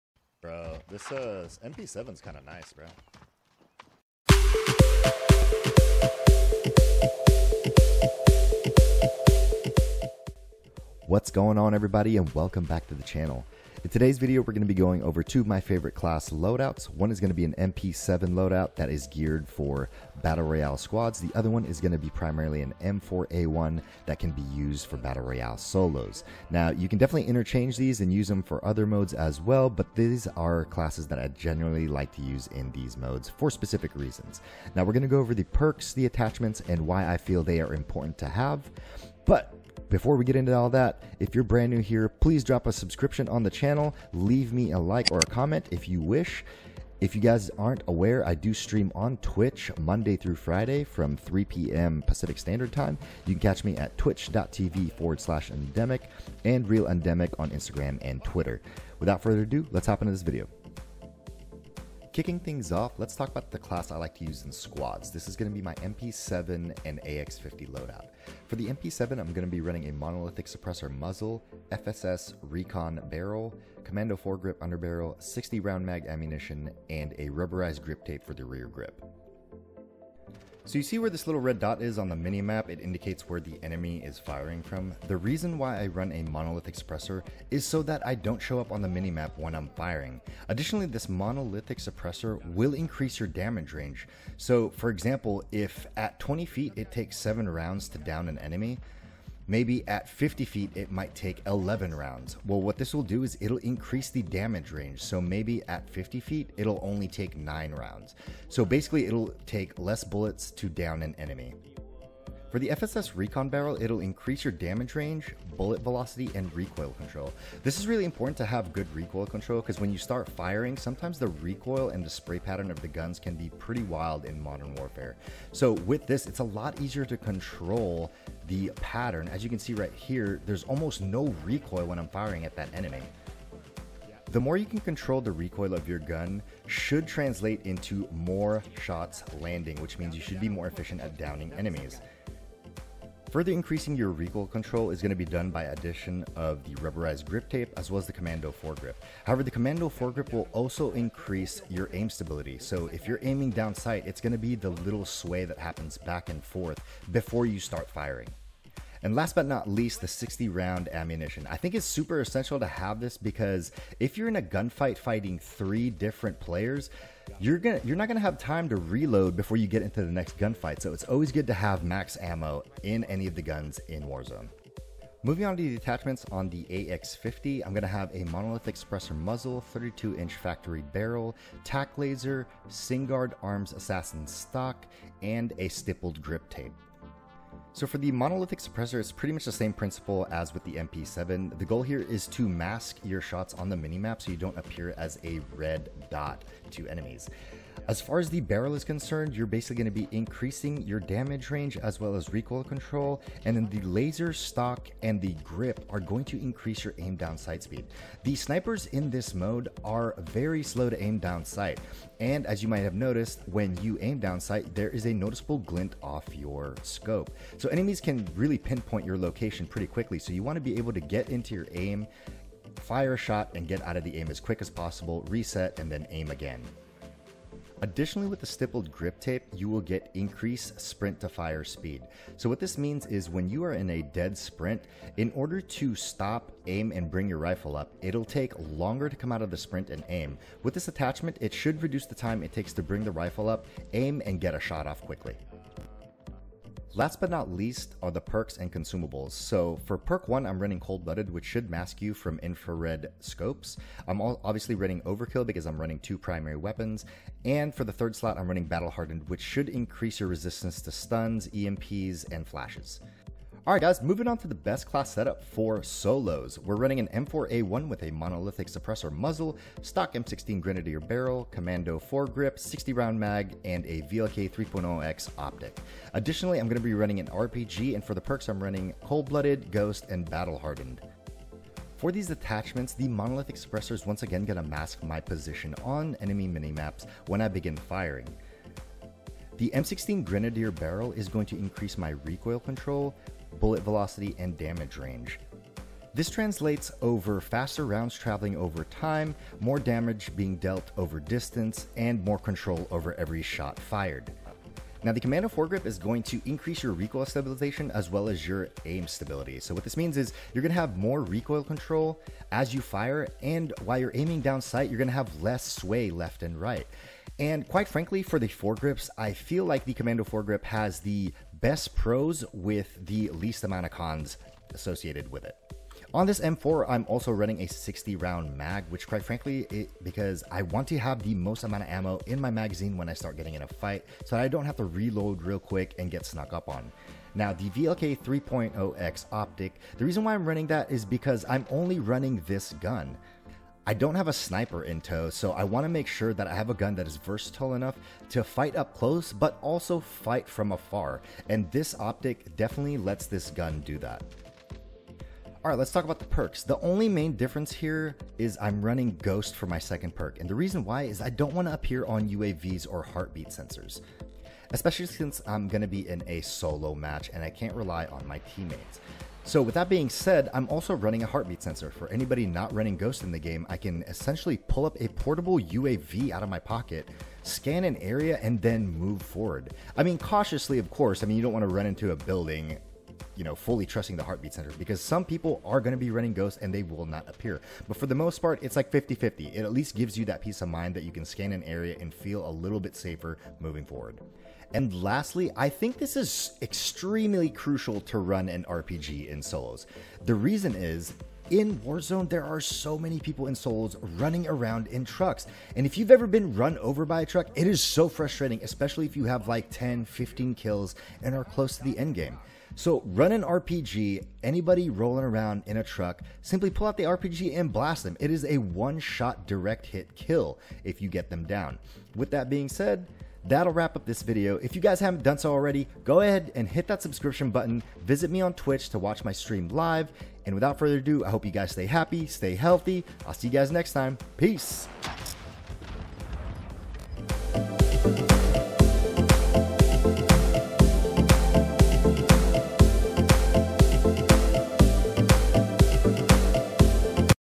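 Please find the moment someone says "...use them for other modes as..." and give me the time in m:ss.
0:28.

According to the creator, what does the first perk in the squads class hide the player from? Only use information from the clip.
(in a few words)
infrared scopes.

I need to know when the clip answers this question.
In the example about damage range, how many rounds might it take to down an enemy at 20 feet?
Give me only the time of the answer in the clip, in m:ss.
1:37.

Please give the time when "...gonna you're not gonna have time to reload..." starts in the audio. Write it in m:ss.
2:47.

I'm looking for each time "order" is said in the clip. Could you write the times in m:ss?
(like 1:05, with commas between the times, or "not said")
3:55.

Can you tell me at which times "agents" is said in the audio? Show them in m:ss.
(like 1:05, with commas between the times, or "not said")
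not said.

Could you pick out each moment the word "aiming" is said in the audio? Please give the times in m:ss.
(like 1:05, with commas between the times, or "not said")
2:33, 5:14.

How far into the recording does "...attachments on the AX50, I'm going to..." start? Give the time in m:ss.
2:55.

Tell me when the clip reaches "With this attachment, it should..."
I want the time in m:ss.
4:00.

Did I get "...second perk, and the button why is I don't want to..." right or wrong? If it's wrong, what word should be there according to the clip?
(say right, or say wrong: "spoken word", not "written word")
wrong: "reason", not "button".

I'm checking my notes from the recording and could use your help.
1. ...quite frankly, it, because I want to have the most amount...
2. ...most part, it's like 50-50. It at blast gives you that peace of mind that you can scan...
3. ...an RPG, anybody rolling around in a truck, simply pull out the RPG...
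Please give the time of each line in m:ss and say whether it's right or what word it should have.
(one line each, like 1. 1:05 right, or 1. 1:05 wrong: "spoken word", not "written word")
1. 5:29 right
2. 6:28 wrong: "least", not "blast"
3. 6:53 right.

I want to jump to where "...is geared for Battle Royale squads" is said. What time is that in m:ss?
0:18.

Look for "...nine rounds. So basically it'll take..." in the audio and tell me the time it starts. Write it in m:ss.
1:47.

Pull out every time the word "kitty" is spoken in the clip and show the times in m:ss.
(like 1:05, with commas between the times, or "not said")
not said.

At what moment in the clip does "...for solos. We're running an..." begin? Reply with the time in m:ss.
4:25.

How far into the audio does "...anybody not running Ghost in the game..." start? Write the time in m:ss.
6:12.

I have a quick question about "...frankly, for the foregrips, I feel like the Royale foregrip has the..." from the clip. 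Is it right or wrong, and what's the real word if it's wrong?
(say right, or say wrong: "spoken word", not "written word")
wrong: "Commando", not "Royale".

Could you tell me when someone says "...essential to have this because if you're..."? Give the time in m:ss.
2:42.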